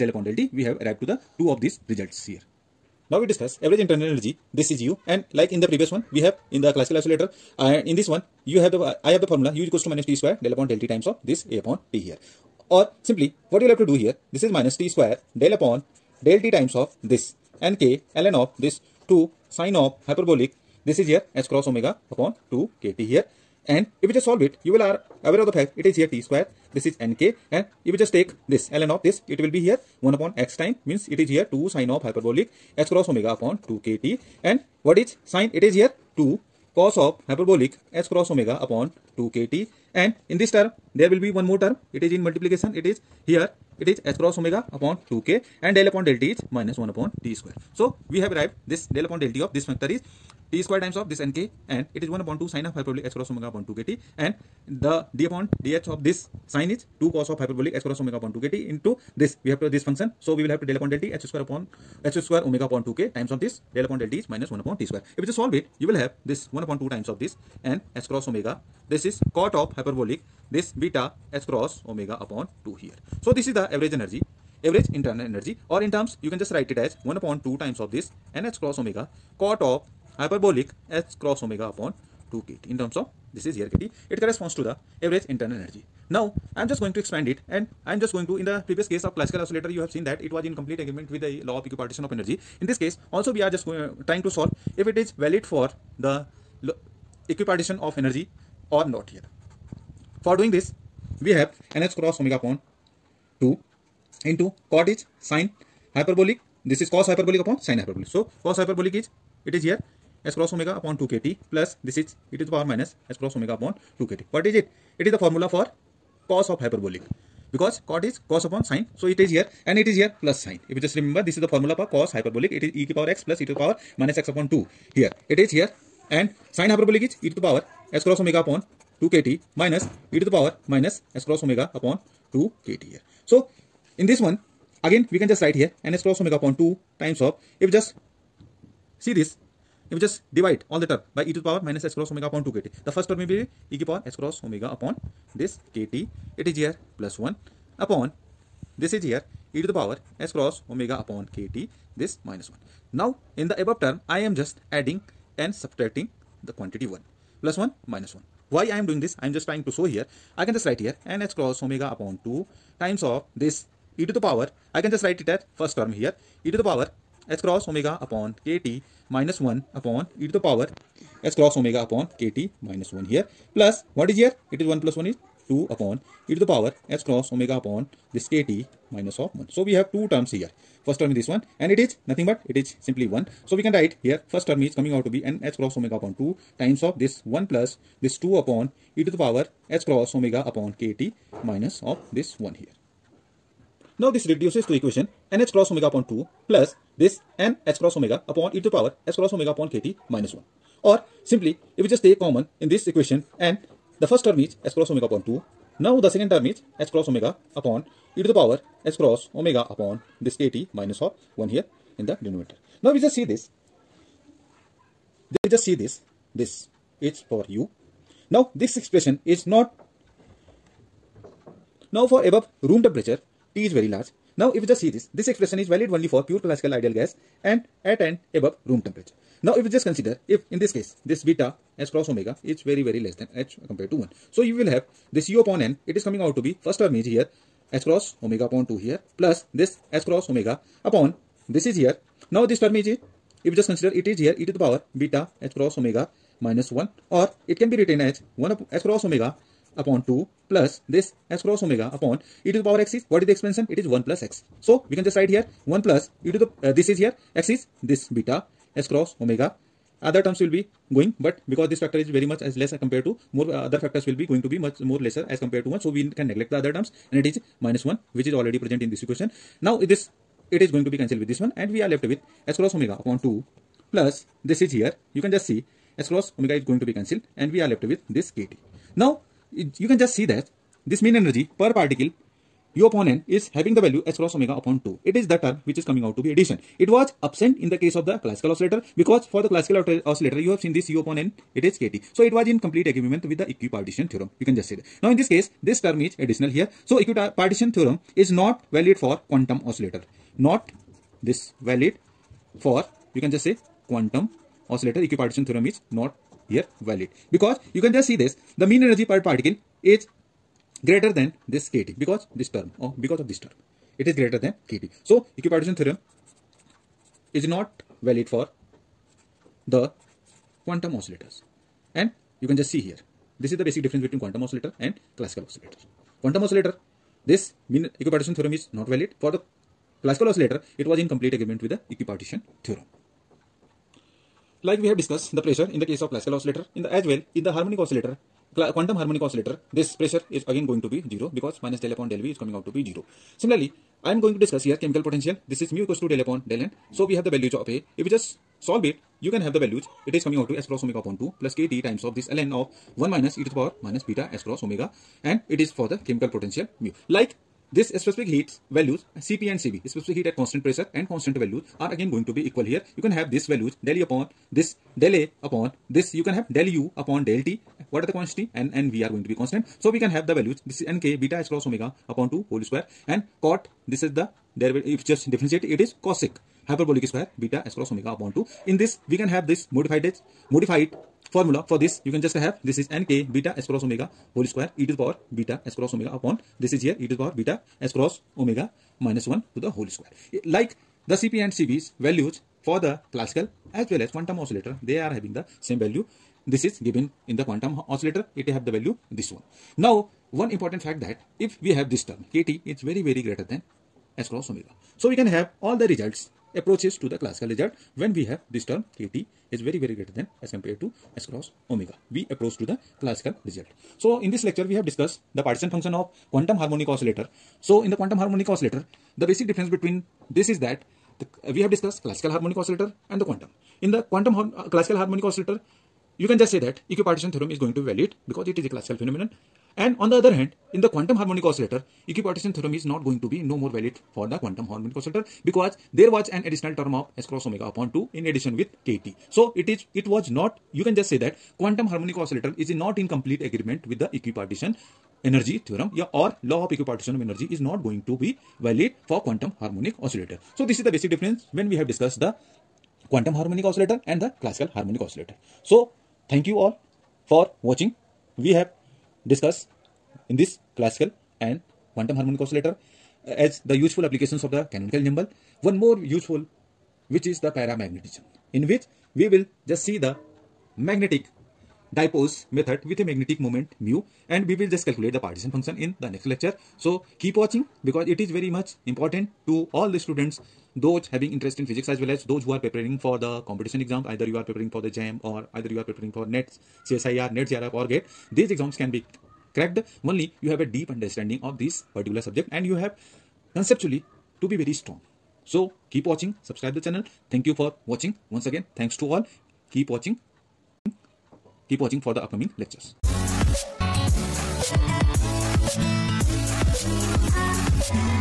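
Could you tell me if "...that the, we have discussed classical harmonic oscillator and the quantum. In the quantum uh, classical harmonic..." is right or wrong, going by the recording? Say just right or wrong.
right.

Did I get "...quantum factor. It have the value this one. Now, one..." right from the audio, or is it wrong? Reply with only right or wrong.
wrong.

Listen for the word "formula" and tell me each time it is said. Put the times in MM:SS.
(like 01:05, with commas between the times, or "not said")
00:09, 01:55, 02:01, 06:21.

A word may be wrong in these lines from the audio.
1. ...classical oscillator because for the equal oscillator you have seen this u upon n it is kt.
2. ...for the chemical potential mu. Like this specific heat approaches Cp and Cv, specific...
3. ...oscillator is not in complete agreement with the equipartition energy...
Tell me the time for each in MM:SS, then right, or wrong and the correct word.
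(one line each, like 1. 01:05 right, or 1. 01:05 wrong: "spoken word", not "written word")
1. 04:48 wrong: "classical", not "equal"
2. 05:55 wrong: "values", not "approaches"
3. 07:22 right.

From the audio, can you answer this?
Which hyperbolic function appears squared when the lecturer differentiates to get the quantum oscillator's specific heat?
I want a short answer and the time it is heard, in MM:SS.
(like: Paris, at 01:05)
cosec hyperbolic, at 06:16.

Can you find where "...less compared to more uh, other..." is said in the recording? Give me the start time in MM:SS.
04:22.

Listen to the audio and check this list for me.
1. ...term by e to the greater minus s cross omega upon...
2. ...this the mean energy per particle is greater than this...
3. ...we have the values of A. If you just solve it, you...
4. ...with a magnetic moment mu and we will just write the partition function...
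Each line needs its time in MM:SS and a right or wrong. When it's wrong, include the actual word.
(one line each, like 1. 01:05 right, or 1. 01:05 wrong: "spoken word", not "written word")
1. 02:20 wrong: "power", not "greater"
2. 05:08 right
3. 05:47 right
4. 07:52 wrong: "calculate", not "write".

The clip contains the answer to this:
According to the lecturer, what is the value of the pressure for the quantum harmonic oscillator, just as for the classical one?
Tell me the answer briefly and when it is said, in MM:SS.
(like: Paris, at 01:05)
0, at 05:39.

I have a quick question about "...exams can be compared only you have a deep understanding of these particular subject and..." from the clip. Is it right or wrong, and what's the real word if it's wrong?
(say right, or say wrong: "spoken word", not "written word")
wrong: "cracked", not "compared".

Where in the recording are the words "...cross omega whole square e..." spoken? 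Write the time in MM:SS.
06:23.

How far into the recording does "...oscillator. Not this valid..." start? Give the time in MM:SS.
04:59.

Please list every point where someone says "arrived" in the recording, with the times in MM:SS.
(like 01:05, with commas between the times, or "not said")
00:00, 00:48.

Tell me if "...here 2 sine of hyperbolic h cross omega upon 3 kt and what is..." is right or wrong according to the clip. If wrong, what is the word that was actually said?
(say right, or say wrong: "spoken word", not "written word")
wrong: "2", not "3".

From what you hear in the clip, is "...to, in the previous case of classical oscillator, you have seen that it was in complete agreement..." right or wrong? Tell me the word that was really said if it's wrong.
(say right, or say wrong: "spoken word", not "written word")
right.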